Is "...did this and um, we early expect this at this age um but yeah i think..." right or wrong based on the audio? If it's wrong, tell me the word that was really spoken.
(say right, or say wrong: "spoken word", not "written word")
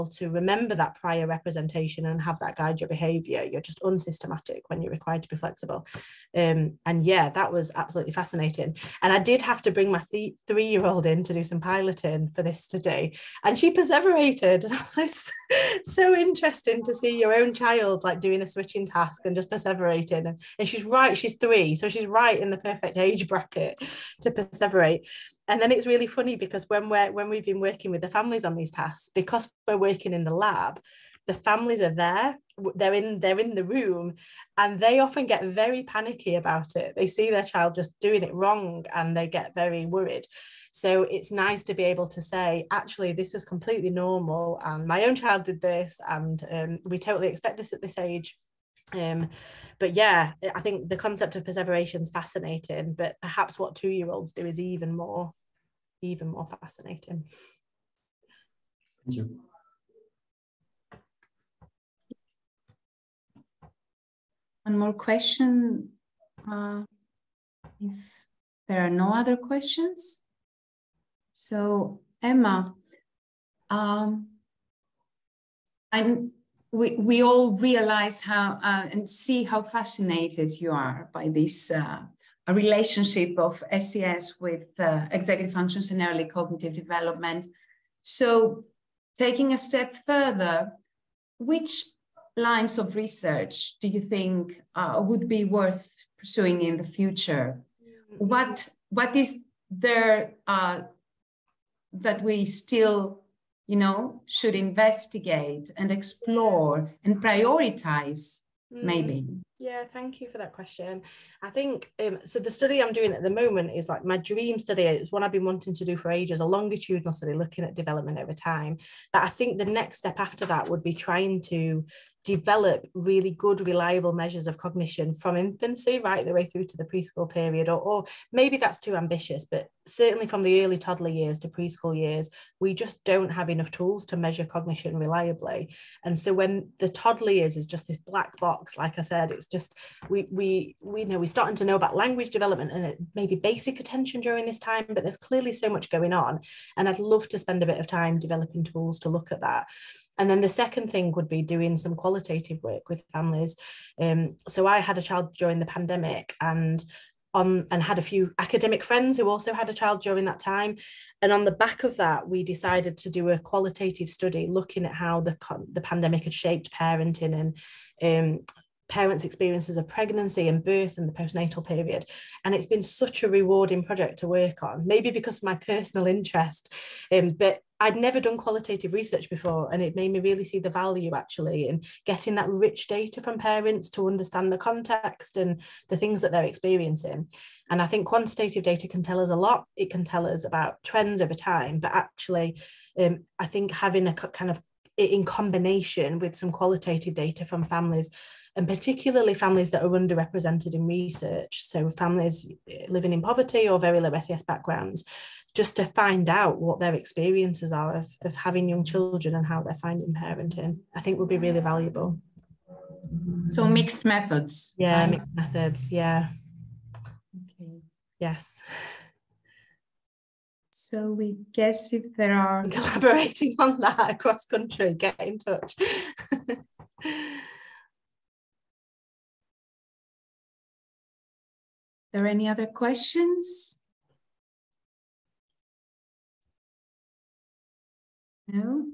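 wrong: "totally", not "early".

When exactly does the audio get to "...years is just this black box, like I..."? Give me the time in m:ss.
2:17.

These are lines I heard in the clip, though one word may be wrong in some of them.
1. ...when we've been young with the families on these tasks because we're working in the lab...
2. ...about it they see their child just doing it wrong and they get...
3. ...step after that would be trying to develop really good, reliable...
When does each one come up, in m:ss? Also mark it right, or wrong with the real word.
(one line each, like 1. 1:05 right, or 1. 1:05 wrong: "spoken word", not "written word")
1. 0:27 wrong: "working", not "young"
2. 0:36 right
3. 1:59 right.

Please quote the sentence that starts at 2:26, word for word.
And I'd love to spend a bit of time developing tools to look at that.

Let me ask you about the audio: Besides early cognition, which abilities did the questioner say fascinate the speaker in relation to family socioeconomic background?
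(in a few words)
executive functions.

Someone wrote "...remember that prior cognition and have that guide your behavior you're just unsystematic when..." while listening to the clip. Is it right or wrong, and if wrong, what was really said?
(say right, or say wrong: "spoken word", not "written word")
wrong: "representation", not "cognition".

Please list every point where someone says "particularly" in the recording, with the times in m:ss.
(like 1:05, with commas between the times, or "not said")
3:18.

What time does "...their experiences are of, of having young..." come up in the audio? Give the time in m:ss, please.
3:26.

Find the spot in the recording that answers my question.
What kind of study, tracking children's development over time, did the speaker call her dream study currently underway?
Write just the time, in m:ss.
1:56.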